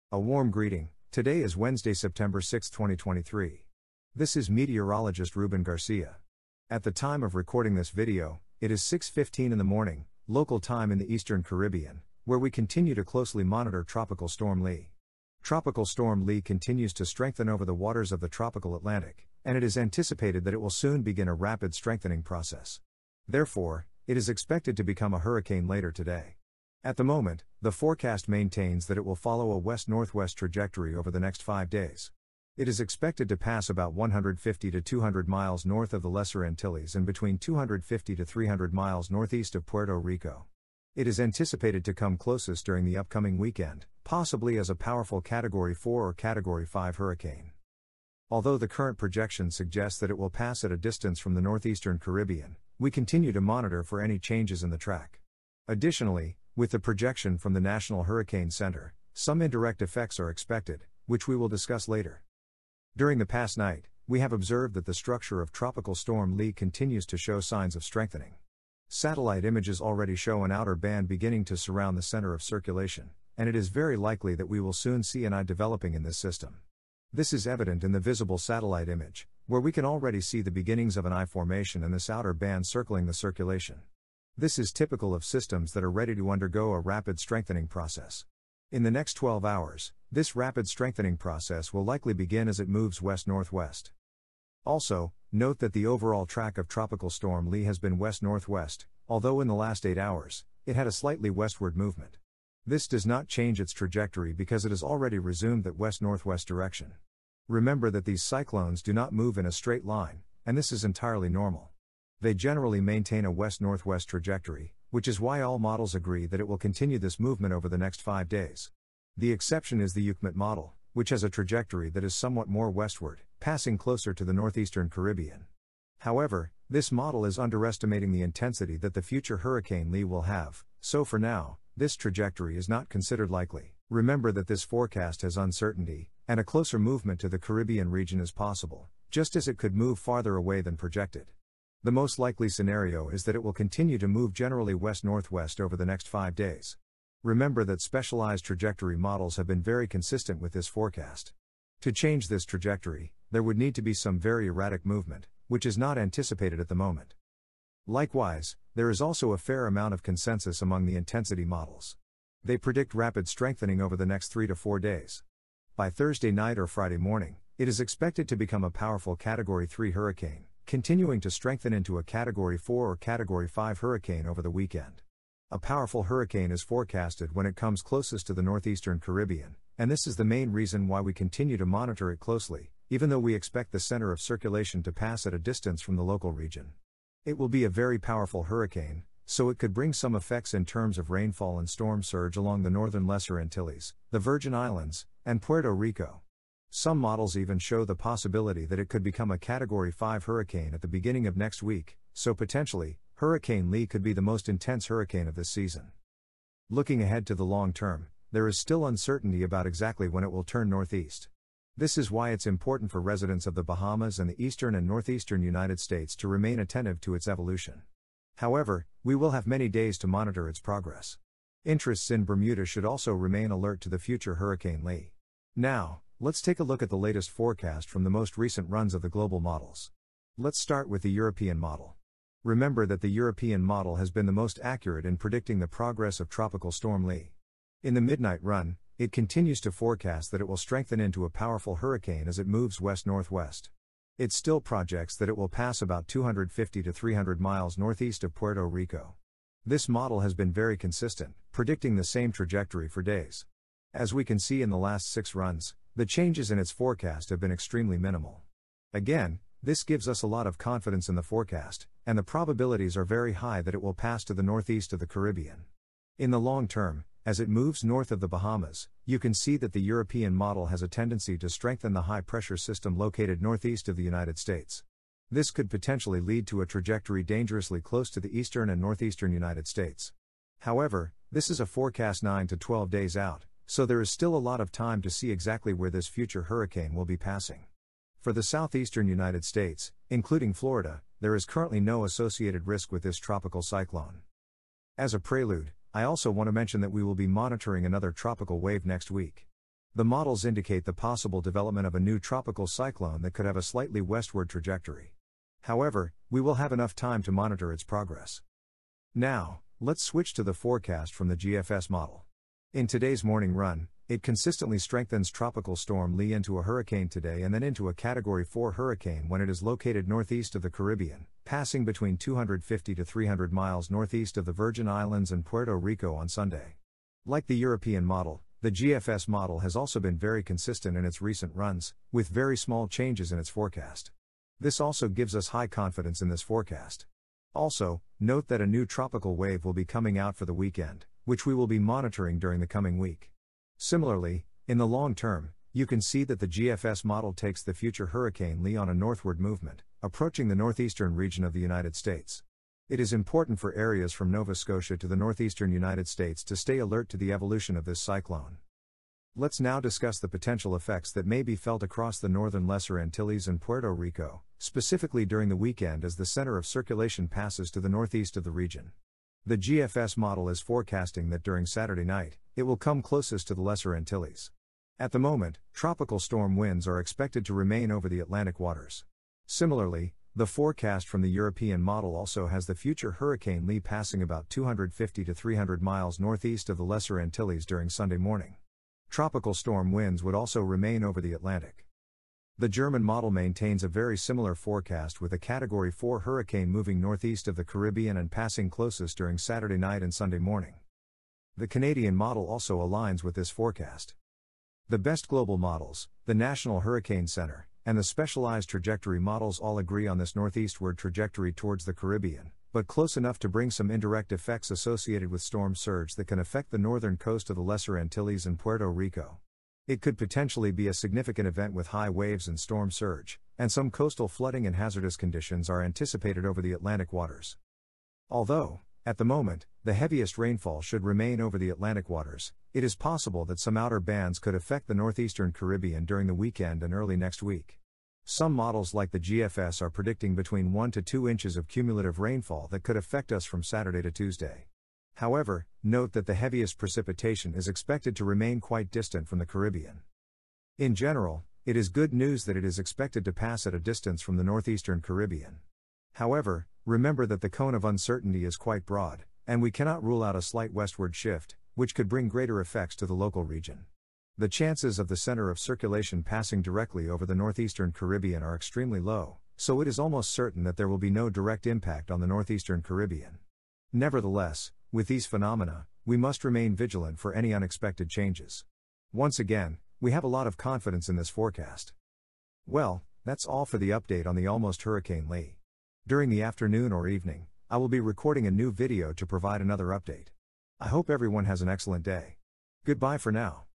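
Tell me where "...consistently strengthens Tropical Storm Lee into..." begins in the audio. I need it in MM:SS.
05:14.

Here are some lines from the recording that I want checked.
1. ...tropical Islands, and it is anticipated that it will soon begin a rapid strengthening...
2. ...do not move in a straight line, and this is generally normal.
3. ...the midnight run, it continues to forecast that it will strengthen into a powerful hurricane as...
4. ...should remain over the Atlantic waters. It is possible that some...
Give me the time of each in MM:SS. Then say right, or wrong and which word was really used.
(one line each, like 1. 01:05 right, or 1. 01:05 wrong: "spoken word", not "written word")
1. 00:18 wrong: "Atlantic", not "Islands"
2. 01:48 wrong: "entirely", not "generally"
3. 03:57 right
4. 07:10 right.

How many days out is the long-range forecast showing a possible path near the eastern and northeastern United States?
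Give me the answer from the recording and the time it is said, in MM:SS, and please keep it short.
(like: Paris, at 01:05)
9 to 12 days, at 04:42.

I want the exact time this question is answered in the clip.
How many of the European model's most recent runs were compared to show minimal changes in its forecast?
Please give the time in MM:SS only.
04:15.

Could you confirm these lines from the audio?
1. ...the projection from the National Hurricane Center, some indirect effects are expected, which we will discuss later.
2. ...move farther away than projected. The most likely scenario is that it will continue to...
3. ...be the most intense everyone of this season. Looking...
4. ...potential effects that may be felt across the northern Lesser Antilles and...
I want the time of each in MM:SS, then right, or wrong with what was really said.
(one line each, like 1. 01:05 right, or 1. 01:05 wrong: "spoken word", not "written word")
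1. 00:56 right
2. 02:19 right
3. 03:24 wrong: "hurricane", not "everyone"
4. 06:00 right.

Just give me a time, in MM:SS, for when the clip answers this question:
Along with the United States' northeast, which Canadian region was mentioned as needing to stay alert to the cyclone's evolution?
05:54.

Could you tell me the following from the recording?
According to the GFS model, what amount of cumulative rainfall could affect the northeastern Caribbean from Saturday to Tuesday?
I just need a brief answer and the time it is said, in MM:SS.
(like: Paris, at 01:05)
1 to 2 inches, at 07:20.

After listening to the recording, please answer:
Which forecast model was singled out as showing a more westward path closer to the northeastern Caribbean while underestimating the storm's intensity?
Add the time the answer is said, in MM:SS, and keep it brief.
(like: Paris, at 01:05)
UKMET, at 02:00.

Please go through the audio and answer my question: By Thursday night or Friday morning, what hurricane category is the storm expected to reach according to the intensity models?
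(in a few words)
Category 3.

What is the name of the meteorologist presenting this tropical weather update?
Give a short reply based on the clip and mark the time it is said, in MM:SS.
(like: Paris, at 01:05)
Ruben Garcia, at 00:05.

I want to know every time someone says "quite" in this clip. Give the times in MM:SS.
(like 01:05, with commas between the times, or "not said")
07:28, 07:38.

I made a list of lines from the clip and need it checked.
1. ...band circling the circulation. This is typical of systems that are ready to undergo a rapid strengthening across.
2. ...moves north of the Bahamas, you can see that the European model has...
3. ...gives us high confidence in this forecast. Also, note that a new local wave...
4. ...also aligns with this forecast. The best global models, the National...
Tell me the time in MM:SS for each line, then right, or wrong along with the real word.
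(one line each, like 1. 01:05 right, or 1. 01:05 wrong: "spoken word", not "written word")
1. 01:22 wrong: "process", not "across"
2. 04:27 right
3. 05:35 wrong: "tropical", not "local"
4. 06:42 right.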